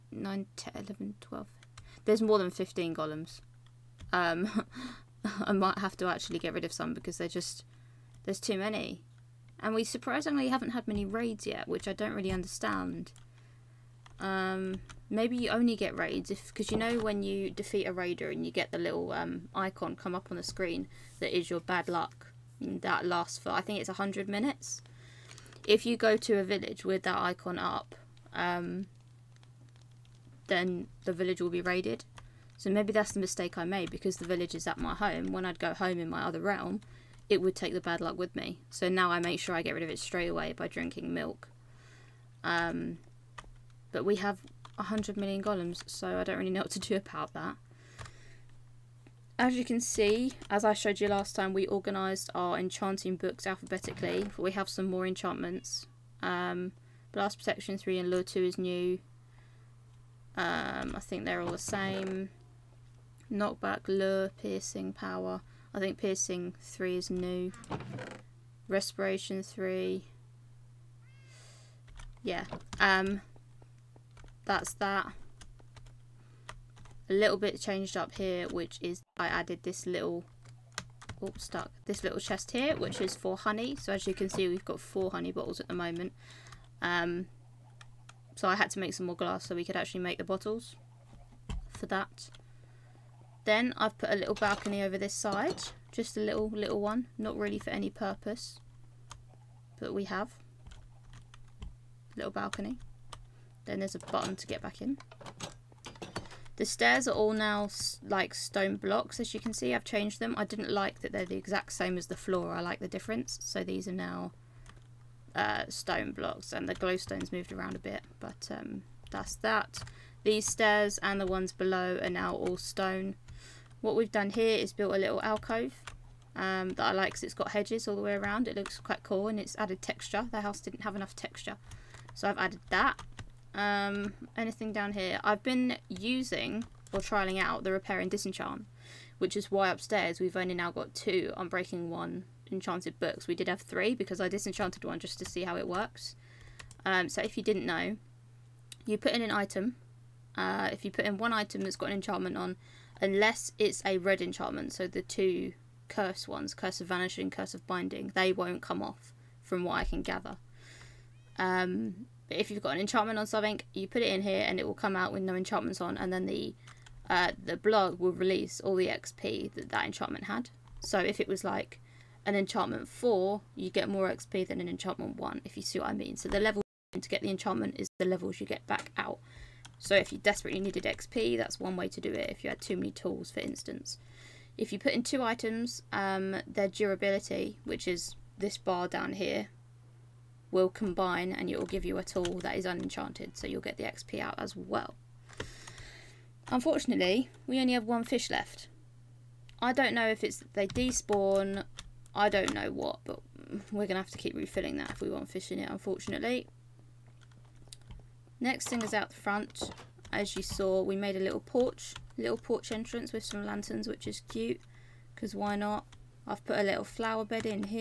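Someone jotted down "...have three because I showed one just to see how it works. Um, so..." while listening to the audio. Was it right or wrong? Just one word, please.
wrong.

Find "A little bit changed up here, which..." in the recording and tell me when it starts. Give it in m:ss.
1:17.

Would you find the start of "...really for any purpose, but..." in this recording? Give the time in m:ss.
1:37.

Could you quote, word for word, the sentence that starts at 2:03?
What we've done here is built a little alcove um, that I like because it's got hedges all the way around.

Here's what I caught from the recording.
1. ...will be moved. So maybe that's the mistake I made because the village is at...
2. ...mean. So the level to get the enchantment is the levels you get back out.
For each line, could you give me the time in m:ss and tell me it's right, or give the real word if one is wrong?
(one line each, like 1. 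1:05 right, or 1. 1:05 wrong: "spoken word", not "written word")
1. 0:31 wrong: "raided", not "moved"
2. 2:55 right.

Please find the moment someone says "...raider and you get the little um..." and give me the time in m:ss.
0:17.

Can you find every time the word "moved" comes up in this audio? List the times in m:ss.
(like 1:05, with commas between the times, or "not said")
1:57.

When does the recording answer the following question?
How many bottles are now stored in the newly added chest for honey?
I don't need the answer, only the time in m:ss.
1:24.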